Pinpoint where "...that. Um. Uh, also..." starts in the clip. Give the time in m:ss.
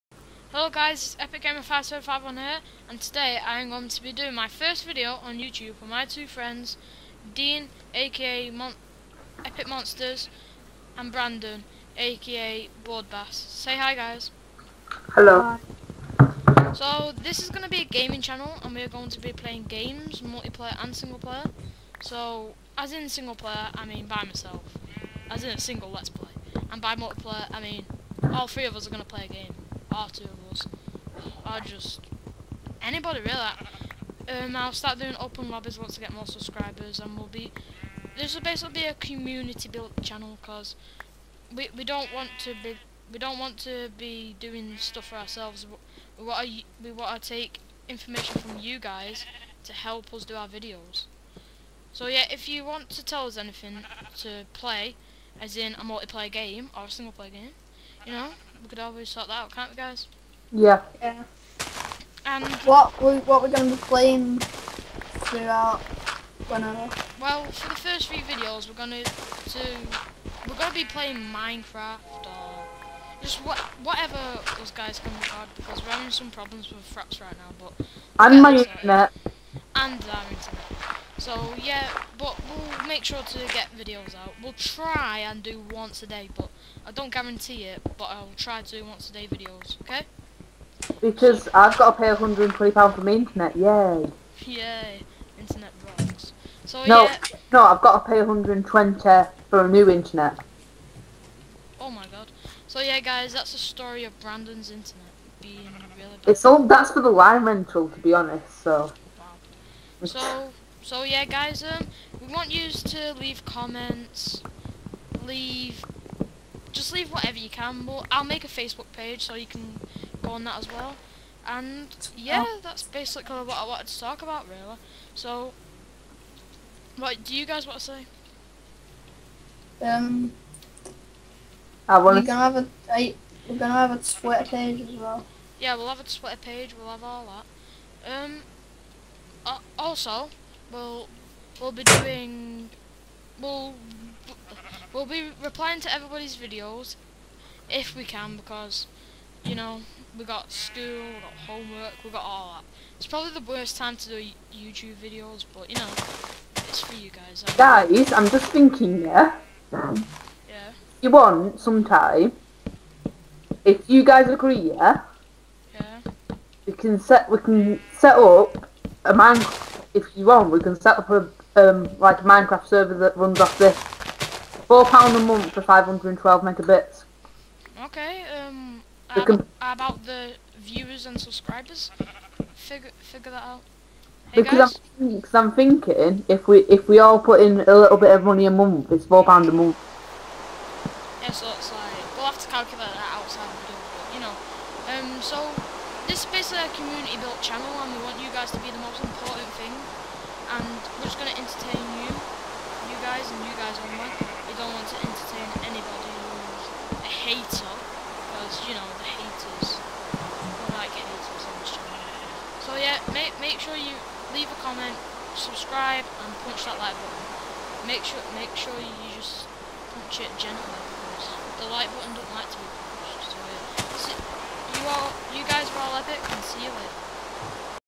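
2:18.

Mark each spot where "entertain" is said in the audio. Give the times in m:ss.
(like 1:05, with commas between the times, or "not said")
3:25.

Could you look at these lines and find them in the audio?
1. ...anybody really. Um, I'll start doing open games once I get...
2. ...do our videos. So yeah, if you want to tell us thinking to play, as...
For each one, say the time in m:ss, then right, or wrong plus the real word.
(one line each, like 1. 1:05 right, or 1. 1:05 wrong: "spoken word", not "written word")
1. 0:32 wrong: "lobbies", not "games"
2. 0:50 wrong: "anything", not "thinking".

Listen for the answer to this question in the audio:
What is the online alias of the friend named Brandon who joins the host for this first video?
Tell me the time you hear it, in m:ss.
0:12.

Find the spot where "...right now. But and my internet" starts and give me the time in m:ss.
1:17.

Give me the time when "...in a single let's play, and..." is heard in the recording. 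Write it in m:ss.
0:25.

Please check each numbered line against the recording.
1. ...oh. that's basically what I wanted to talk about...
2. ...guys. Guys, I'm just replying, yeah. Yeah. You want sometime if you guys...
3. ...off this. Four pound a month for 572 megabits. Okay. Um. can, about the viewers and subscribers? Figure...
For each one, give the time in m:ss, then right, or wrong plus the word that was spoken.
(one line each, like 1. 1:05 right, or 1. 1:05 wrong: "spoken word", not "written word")
1. 2:02 right
2. 2:37 wrong: "thinking", not "replying"
3. 2:53 wrong: "512", not "572".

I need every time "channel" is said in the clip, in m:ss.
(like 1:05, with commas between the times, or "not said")
0:18, 0:40, 3:17, 3:31.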